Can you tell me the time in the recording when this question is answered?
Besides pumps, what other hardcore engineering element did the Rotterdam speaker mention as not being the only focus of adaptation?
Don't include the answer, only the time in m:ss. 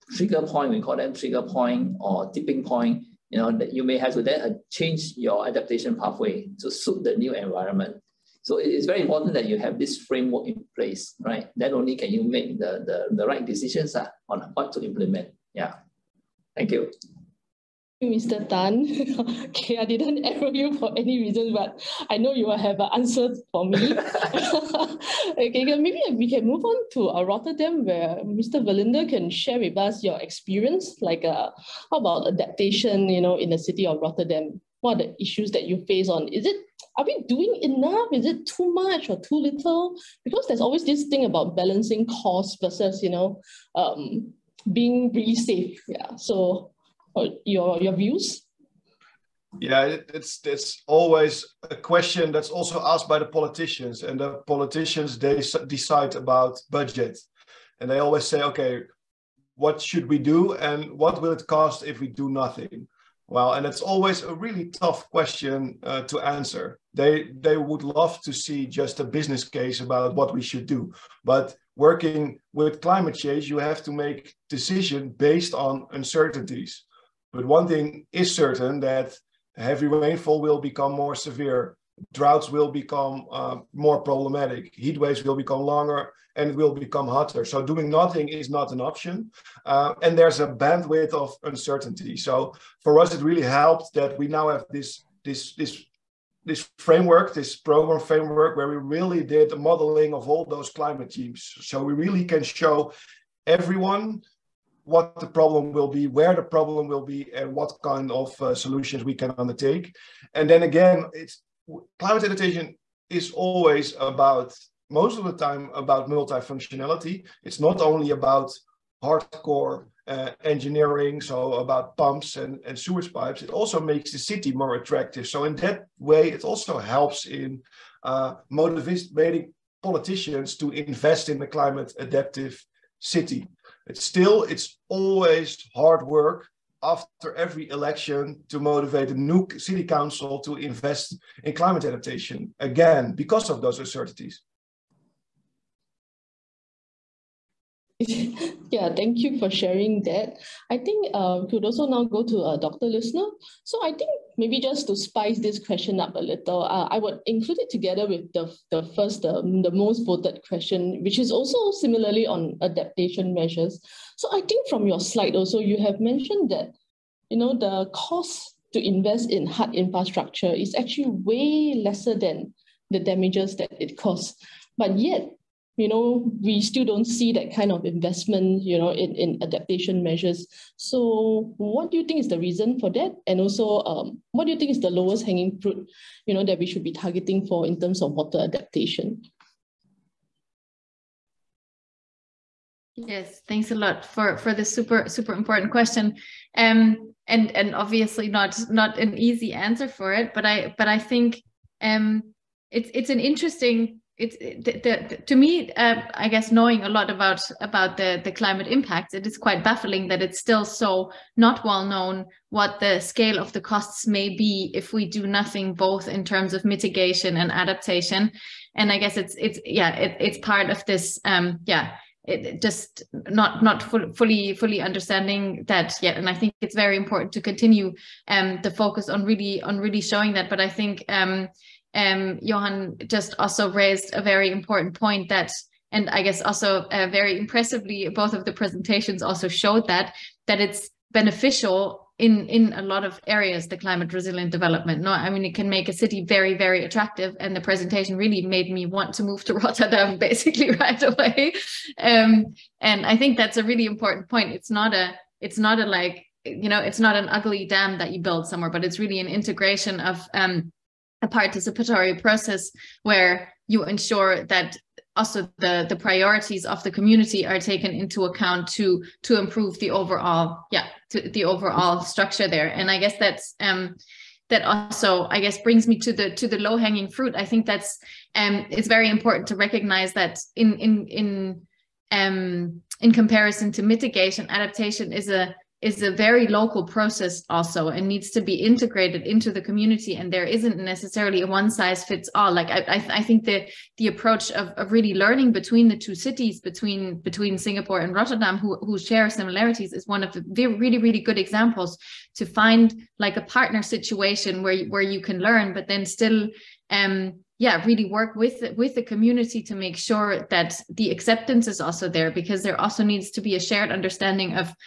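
2:02.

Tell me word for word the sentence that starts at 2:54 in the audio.
But yet, you know, we still don't see that kind of investment, you know, in, in adaptation measures.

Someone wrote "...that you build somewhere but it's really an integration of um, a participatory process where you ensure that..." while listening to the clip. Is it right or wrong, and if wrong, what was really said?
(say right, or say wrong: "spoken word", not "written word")
right.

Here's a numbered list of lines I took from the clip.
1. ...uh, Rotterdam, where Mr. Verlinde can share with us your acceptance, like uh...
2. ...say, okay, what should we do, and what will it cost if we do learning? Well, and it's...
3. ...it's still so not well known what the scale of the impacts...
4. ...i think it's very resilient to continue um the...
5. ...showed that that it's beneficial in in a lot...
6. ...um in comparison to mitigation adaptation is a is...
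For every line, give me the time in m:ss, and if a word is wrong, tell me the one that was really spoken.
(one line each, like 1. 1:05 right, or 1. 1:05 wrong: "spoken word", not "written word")
1. 0:27 wrong: "experience", not "acceptance"
2. 0:58 wrong: "nothing", not "learning"
3. 3:30 wrong: "costs", not "impacts"
4. 3:46 wrong: "important", not "resilient"
5. 3:59 right
6. 4:42 right.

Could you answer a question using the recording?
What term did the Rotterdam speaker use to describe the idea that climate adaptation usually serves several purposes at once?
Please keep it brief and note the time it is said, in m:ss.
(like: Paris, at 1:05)
multifunctionality, at 1:56.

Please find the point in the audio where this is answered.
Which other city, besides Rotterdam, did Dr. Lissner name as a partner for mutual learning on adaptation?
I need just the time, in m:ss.
4:57.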